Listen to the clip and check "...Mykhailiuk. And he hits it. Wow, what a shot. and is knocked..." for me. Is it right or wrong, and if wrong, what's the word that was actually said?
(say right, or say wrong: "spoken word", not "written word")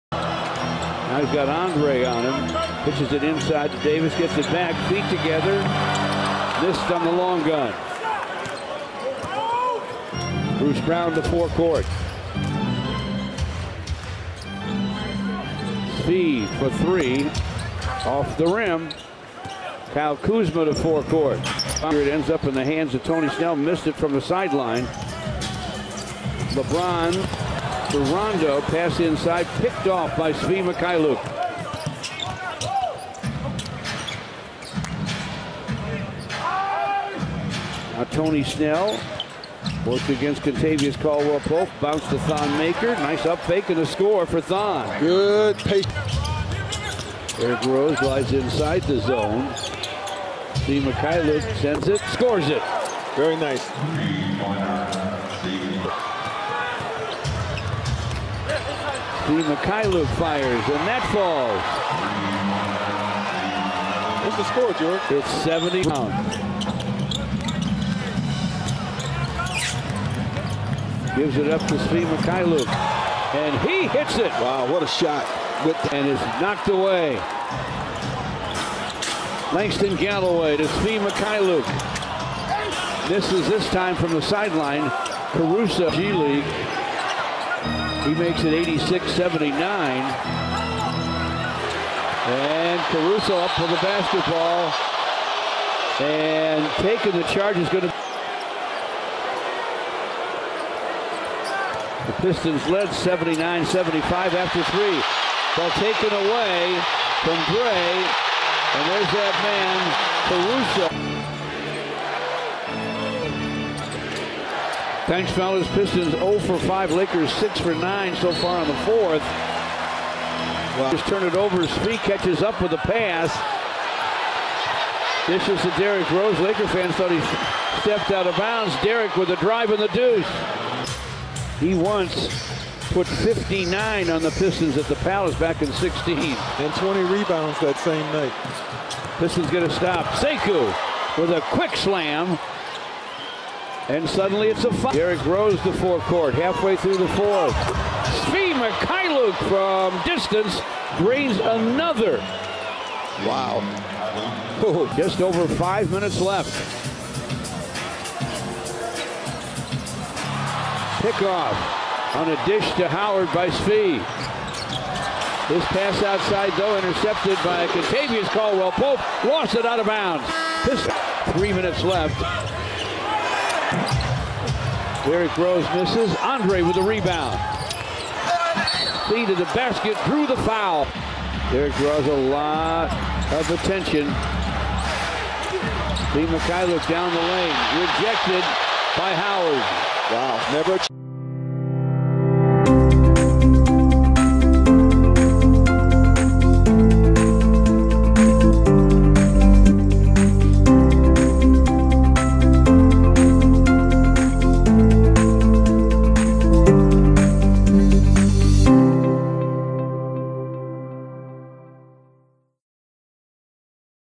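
right.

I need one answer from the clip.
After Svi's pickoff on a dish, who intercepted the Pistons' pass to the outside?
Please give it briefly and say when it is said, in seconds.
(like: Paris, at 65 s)
Kentavious Caldwell-Pope, at 167 s.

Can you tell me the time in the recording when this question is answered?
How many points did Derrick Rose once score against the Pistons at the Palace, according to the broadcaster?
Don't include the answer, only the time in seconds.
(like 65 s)
133 s.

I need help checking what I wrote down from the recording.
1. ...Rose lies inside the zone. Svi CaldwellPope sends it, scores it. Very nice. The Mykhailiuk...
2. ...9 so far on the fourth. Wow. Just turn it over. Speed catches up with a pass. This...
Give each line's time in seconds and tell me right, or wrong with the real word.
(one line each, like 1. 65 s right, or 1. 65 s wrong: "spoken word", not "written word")
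1. 47 s wrong: "Mykhailiuk", not "CaldwellPope"
2. 117 s right.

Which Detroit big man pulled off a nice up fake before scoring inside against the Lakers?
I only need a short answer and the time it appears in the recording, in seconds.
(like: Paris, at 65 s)
Thon Maker, at 42 s.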